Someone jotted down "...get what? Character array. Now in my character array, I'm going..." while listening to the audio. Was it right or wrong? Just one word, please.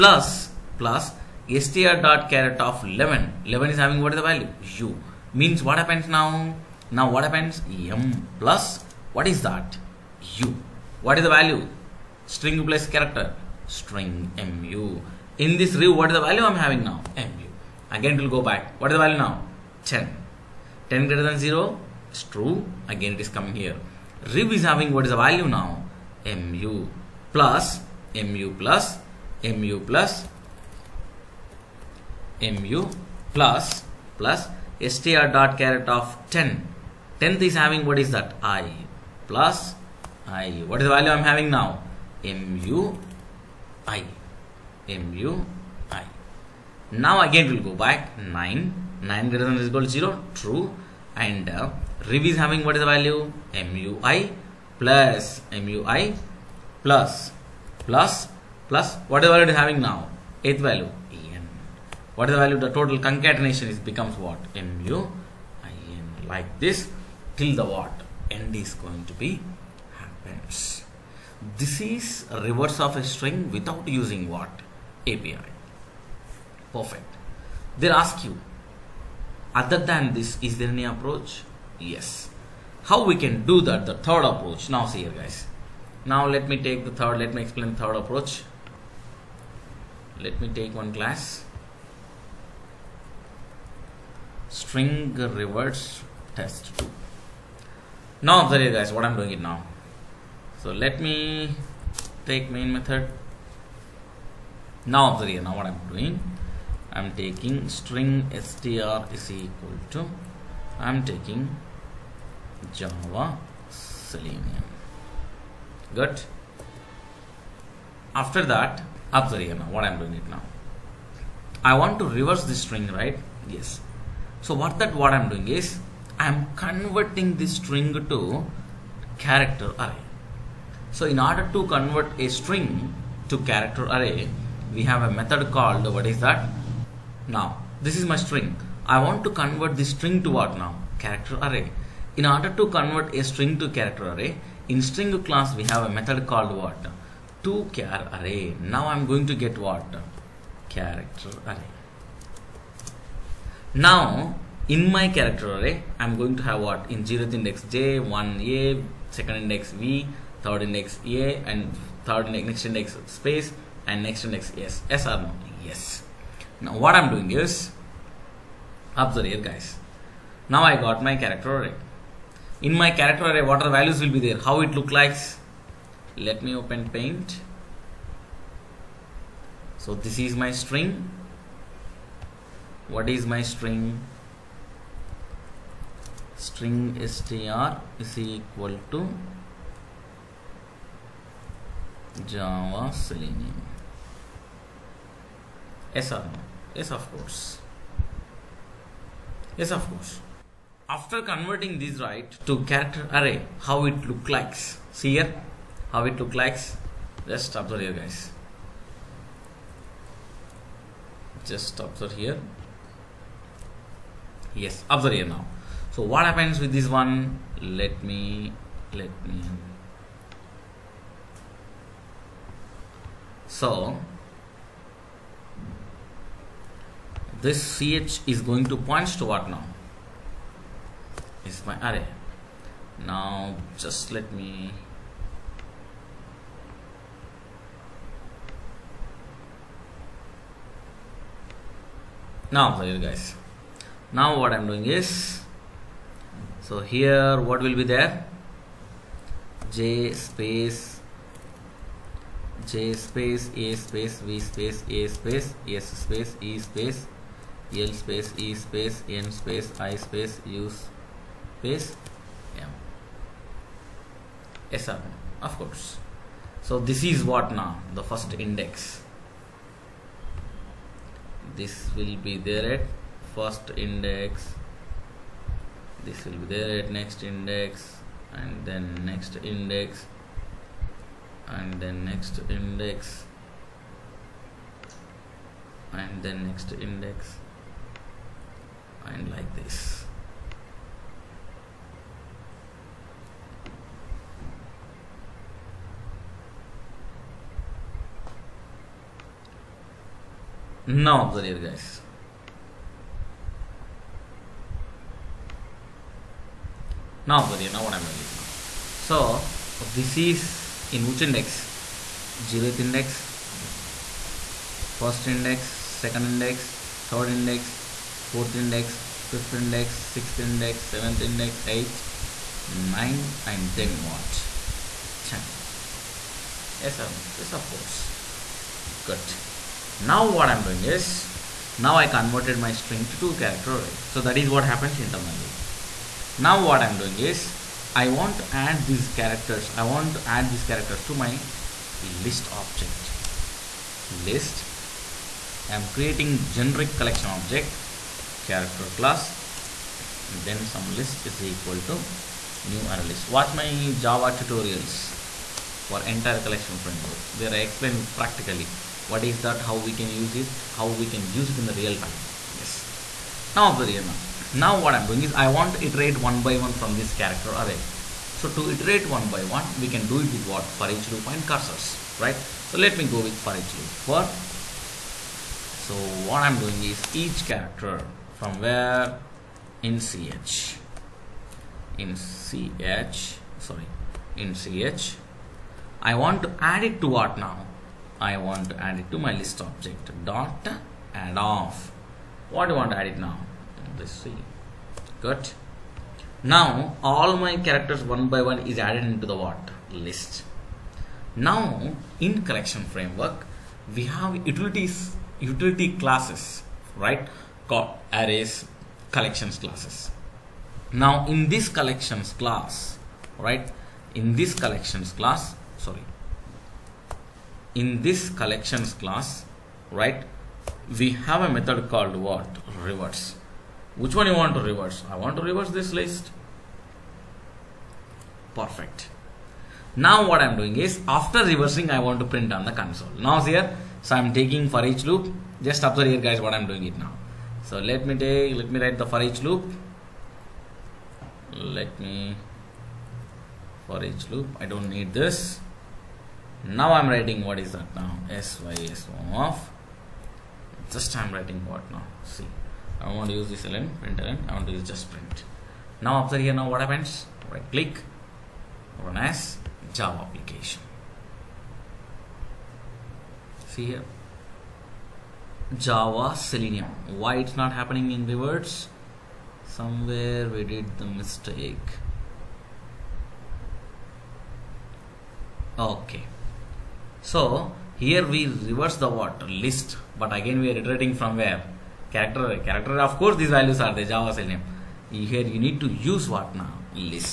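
right.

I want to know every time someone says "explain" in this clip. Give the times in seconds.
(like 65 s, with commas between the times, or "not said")
87 s, 357 s.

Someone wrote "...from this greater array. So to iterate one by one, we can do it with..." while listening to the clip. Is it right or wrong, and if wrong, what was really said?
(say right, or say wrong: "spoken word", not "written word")
wrong: "character", not "greater".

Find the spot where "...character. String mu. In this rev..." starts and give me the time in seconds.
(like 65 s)
12 s.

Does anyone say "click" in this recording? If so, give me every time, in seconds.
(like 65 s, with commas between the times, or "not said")
457 s.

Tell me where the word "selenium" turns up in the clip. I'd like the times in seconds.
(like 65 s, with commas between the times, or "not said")
113 s, 192 s, 466 s, 484 s.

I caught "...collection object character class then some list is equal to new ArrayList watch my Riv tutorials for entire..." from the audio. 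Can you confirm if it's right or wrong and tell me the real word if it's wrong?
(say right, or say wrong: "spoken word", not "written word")
wrong: "Java", not "Riv".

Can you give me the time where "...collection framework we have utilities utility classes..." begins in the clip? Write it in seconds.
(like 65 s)
402 s.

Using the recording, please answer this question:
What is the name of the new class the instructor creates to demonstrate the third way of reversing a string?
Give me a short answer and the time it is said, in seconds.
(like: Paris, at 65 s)
String reverse test 2, at 94 s.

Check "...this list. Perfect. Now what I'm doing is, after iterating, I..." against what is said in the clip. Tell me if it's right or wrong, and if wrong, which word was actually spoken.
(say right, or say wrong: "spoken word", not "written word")
wrong: "reversing", not "iterating".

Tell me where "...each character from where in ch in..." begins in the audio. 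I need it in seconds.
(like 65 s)
377 s.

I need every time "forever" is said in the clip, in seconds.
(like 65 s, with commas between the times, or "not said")
not said.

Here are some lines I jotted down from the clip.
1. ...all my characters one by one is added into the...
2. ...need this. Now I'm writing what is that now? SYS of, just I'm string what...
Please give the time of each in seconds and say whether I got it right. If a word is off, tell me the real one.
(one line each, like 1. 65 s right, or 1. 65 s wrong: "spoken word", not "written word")
1. 397 s right
2. 444 s wrong: "writing", not "string".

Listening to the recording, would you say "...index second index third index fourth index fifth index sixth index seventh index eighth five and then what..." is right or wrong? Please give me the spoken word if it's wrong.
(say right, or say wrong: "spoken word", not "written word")
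wrong: "nine", not "five".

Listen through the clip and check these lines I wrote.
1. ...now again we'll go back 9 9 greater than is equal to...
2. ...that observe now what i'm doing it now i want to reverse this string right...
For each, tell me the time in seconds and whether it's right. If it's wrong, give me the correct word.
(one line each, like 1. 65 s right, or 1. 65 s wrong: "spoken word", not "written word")
1. 46 s right
2. 118 s right.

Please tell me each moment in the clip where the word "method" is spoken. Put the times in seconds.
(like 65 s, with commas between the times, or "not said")
102 s, 135 s, 145 s, 421 s.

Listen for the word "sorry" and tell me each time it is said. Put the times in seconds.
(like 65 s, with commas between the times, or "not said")
383 s, 415 s.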